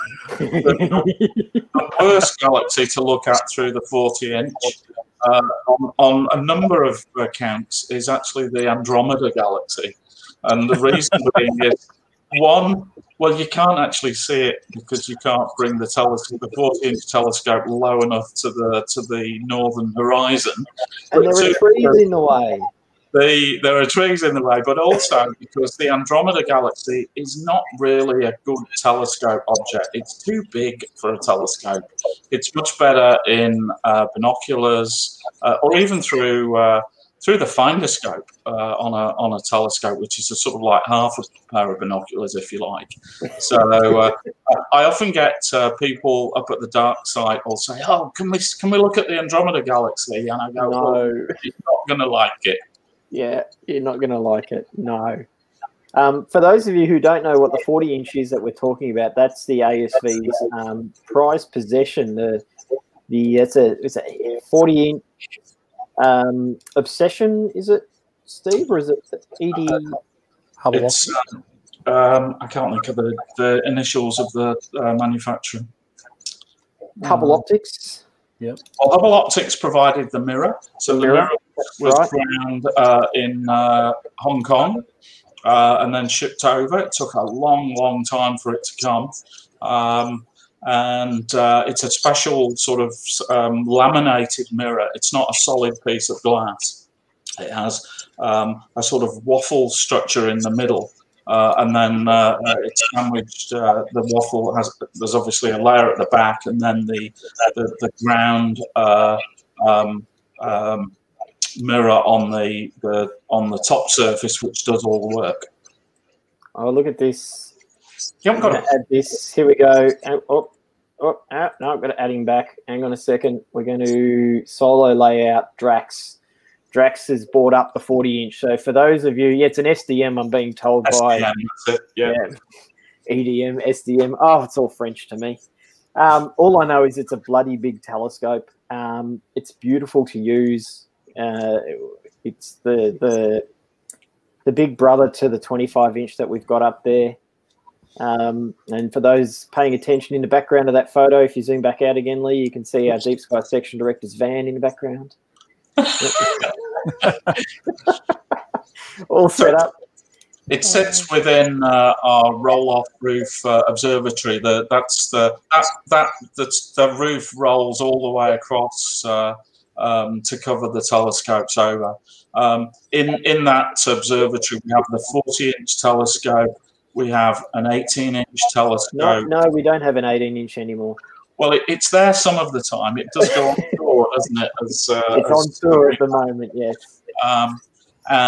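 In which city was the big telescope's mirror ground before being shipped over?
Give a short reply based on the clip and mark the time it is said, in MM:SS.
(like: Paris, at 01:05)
Hong Kong, at 01:24.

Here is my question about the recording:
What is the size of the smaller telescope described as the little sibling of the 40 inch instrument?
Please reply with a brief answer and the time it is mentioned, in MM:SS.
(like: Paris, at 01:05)
25 inch, at 02:25.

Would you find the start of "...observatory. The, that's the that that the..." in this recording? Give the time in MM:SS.
02:43.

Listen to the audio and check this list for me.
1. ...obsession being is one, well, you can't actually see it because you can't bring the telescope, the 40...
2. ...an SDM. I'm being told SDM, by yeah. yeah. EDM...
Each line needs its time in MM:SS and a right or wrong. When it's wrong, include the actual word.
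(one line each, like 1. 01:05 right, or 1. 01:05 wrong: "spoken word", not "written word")
1. 00:10 wrong: "reason", not "obsession"
2. 02:09 right.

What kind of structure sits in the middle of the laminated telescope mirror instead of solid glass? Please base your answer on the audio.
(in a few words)
Waffle structure.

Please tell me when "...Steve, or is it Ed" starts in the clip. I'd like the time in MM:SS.
01:08.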